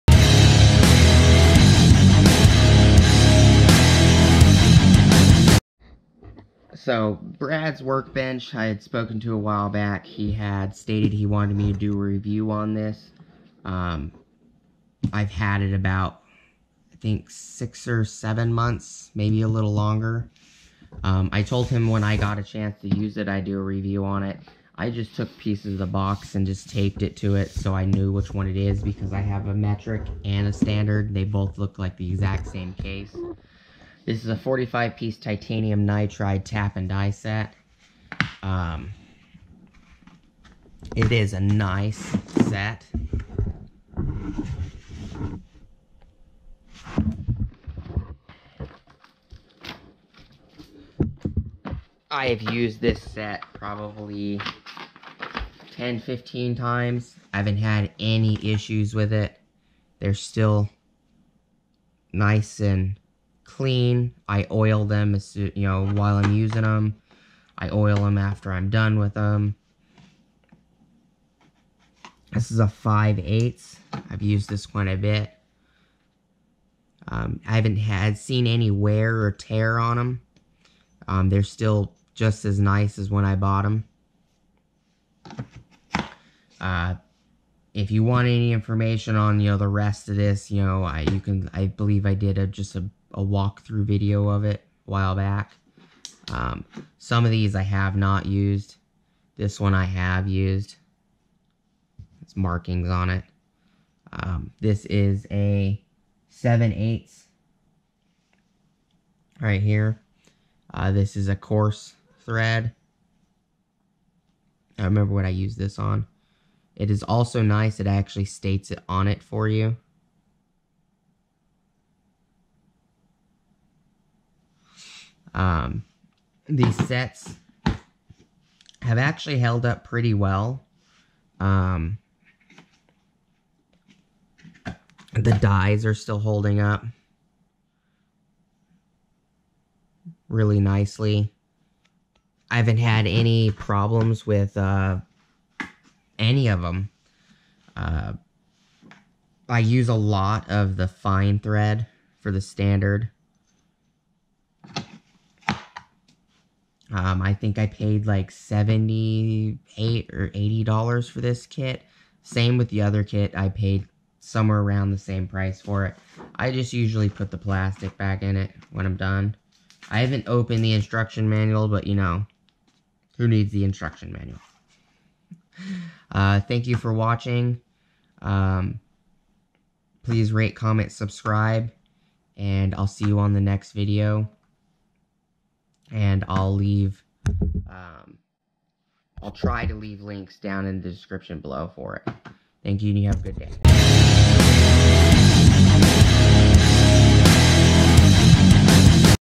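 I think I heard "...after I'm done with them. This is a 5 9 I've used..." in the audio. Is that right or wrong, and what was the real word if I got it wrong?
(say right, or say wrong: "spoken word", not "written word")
wrong: "8", not "9".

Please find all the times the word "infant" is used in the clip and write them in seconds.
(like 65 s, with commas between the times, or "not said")
not said.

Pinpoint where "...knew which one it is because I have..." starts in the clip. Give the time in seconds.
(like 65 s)
27 s.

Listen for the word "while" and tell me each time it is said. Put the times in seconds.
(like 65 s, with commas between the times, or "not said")
9 s, 65 s, 94 s.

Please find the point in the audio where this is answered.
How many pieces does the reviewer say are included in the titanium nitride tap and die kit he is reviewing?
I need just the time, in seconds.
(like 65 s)
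34 s.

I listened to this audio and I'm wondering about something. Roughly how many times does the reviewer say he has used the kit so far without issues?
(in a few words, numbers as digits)
10 to 15.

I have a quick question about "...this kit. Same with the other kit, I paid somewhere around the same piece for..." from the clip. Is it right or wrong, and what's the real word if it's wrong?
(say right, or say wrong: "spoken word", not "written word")
wrong: "price", not "piece".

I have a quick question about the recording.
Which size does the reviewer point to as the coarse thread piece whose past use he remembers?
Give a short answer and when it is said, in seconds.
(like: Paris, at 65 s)
7/8, at 106 s.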